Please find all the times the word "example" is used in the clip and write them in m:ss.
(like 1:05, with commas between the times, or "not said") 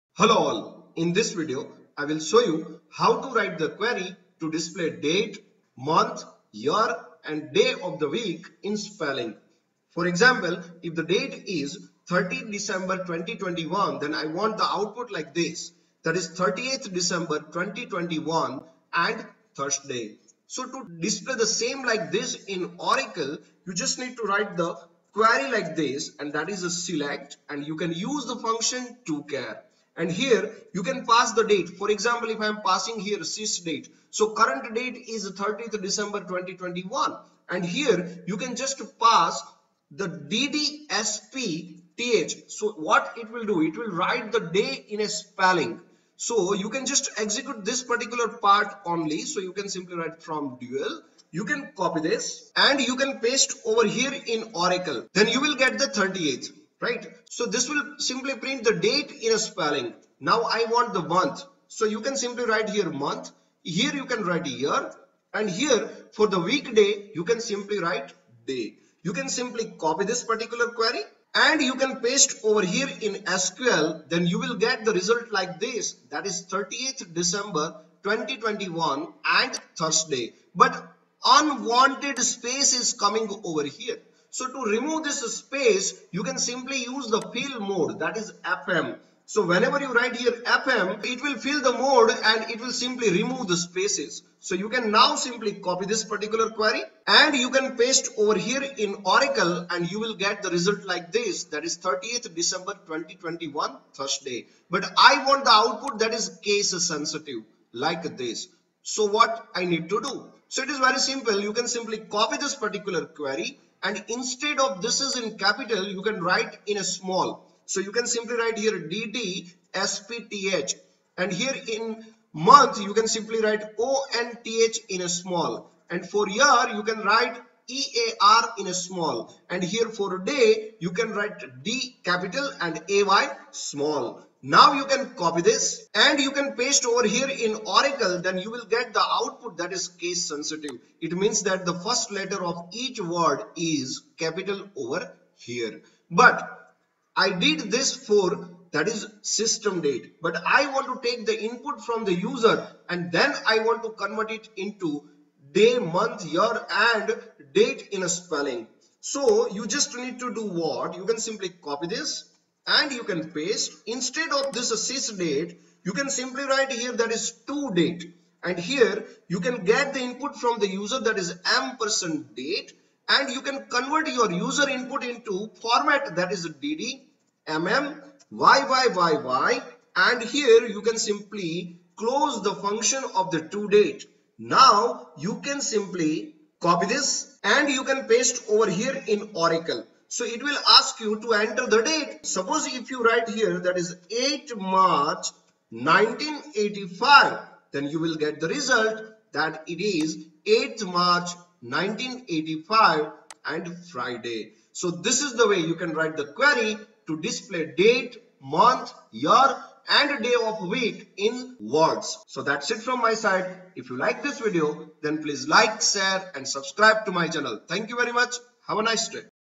0:10, 0:31.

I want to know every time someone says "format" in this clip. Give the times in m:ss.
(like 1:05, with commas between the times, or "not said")
2:55.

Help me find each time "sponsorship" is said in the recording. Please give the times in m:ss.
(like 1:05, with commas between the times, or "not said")
not said.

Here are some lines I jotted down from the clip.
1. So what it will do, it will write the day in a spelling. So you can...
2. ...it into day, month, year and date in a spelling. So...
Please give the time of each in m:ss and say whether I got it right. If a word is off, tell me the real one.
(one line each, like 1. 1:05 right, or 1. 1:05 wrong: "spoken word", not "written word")
1. 0:42 right
2. 2:34 right.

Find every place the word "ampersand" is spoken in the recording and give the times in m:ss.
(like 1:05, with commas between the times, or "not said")
2:51.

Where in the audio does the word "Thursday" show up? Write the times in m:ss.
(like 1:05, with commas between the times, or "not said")
0:19, 1:19, 1:43.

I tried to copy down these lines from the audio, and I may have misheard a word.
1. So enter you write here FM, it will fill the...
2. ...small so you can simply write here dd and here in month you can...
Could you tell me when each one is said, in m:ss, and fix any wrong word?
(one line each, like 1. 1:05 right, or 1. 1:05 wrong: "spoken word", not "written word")
1. 1:29 wrong: "whenever", not "enter"
2. 1:56 right.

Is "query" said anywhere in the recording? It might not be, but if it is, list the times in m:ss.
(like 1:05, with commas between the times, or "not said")
0:03, 0:25, 1:10, 1:36, 1:53, 3:26.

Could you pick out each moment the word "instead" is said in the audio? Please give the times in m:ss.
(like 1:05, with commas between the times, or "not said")
1:54, 2:43.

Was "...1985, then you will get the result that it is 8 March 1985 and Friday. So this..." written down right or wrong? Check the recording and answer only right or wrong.
right.